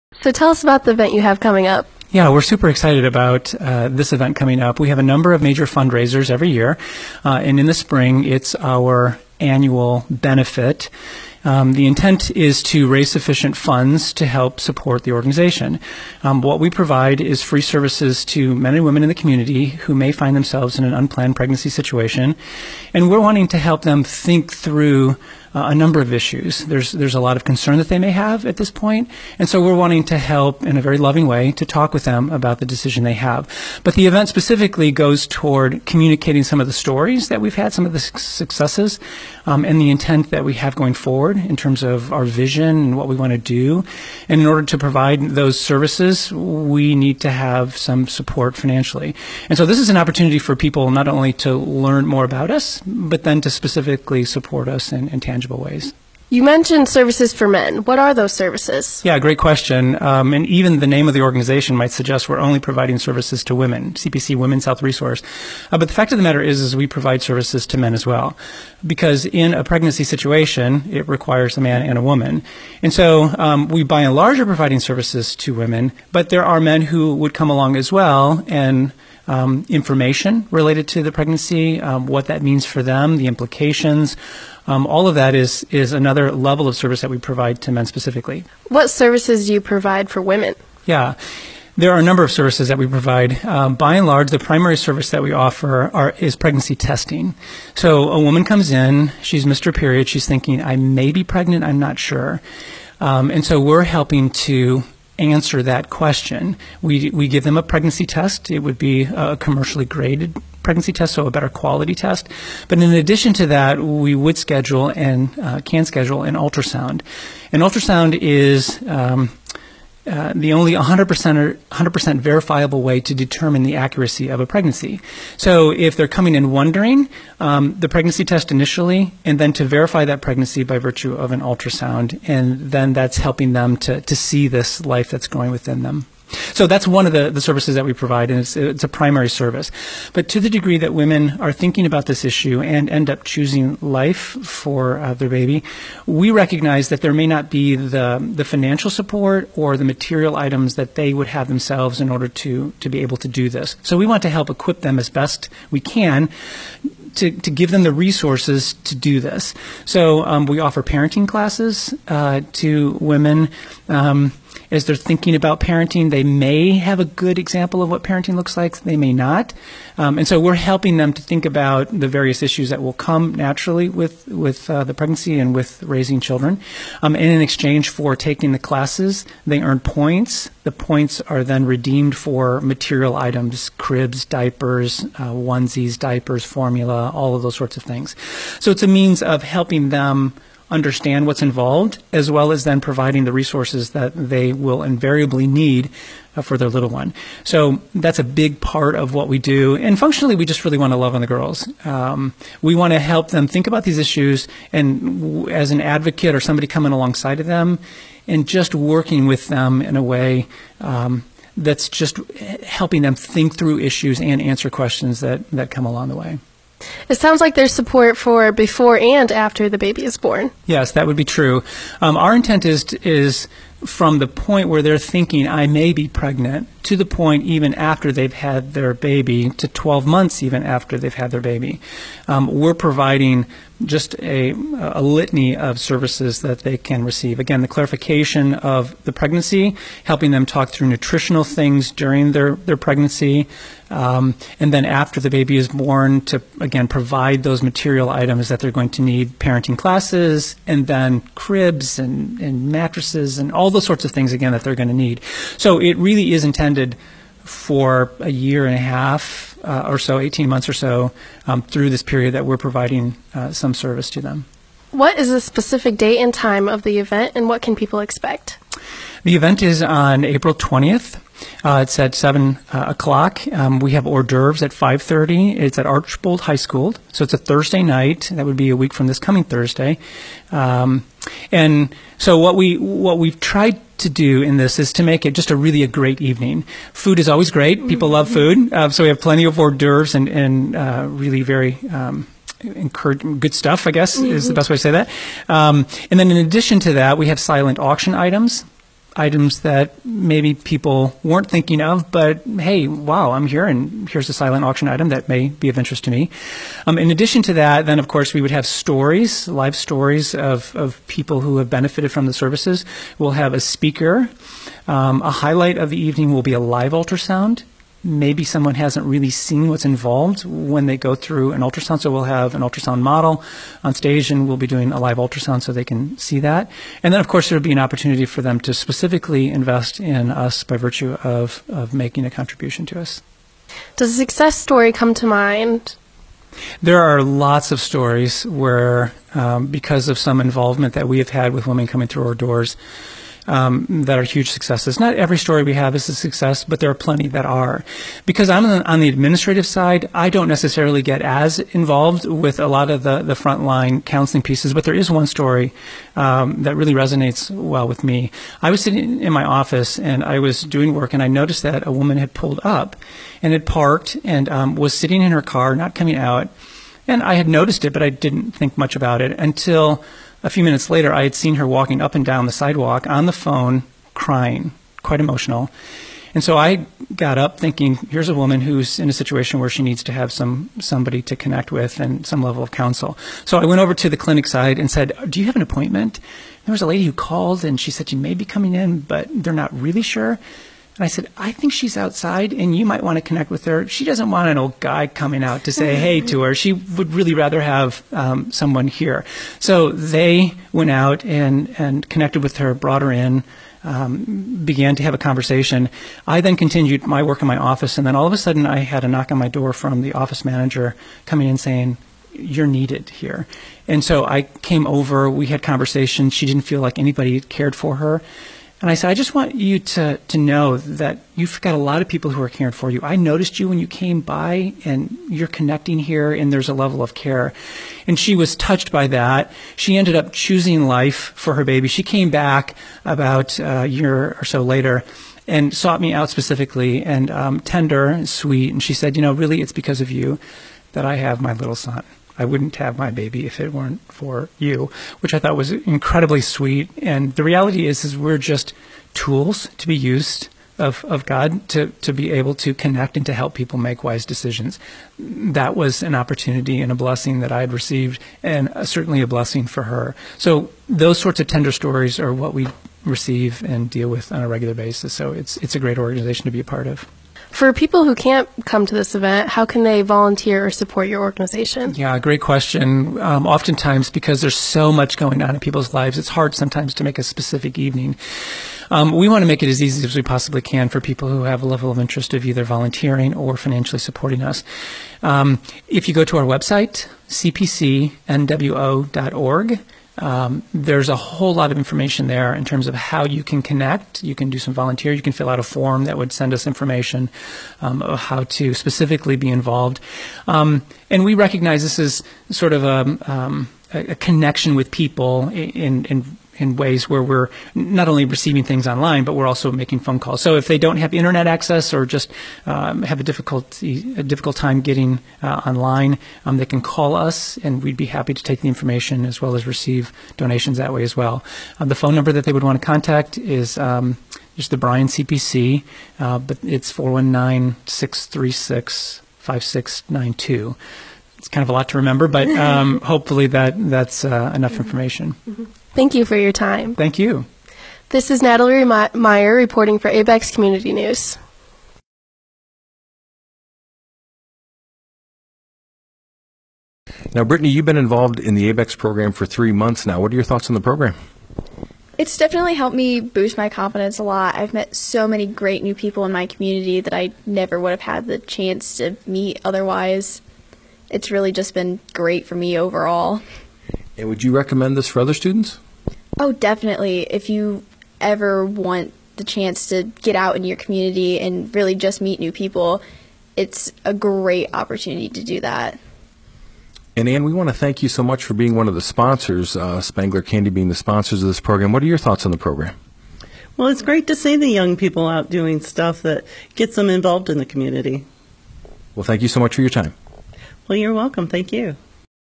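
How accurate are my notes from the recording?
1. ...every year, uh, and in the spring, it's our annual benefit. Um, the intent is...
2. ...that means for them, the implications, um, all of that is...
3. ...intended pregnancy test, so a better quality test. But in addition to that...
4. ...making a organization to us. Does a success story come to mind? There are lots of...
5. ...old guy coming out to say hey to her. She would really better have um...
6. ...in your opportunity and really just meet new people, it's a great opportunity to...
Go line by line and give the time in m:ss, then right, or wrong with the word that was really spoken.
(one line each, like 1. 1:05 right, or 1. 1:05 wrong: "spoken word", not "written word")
1. 0:06 right
2. 1:22 right
3. 1:49 wrong: "graded", not "intended"
4. 5:31 wrong: "contribution", not "organization"
5. 6:34 wrong: "rather", not "better"
6. 9:30 wrong: "community", not "opportunity".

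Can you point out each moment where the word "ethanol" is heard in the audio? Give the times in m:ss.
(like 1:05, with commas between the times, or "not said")
not said.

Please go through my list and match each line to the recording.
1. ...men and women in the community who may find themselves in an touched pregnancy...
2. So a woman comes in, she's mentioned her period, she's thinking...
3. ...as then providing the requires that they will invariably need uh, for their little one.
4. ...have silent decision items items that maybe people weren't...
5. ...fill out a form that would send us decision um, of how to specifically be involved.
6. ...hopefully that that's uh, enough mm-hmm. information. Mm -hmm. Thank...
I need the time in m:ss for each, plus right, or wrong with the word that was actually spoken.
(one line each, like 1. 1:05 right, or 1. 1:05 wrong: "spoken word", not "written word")
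1. 0:18 wrong: "unplanned", not "touched"
2. 1:37 wrong: "missed", not "mentioned"
3. 3:12 wrong: "resources", not "requires"
4. 4:57 wrong: "auction", not "decision"
5. 8:15 wrong: "information", not "decision"
6. 8:53 right.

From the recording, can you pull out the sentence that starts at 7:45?
So it's it's a great organization to be a part of.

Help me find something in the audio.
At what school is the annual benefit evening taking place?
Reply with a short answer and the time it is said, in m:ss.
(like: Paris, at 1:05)
Archbold High School, at 4:35.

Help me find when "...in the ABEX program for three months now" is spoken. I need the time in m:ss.
9:08.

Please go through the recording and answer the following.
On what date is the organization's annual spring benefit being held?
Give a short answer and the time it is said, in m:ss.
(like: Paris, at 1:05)
April 20, at 4:30.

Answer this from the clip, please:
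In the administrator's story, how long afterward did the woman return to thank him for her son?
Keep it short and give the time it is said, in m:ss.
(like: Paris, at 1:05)
About a year, at 7:13.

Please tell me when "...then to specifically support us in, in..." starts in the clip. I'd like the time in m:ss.
0:53.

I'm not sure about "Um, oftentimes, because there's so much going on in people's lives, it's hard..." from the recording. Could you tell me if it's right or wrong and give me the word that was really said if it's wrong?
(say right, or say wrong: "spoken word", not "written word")
right.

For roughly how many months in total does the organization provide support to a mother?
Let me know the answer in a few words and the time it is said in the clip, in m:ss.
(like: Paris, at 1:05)
18 months, at 4:20.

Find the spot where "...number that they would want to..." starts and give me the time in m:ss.
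8:42.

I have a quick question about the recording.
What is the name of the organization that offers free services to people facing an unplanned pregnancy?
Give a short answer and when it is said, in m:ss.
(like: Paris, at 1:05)
CPC Women's Health Resource, at 1:03.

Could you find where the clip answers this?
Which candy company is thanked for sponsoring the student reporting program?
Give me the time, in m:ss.
9:40.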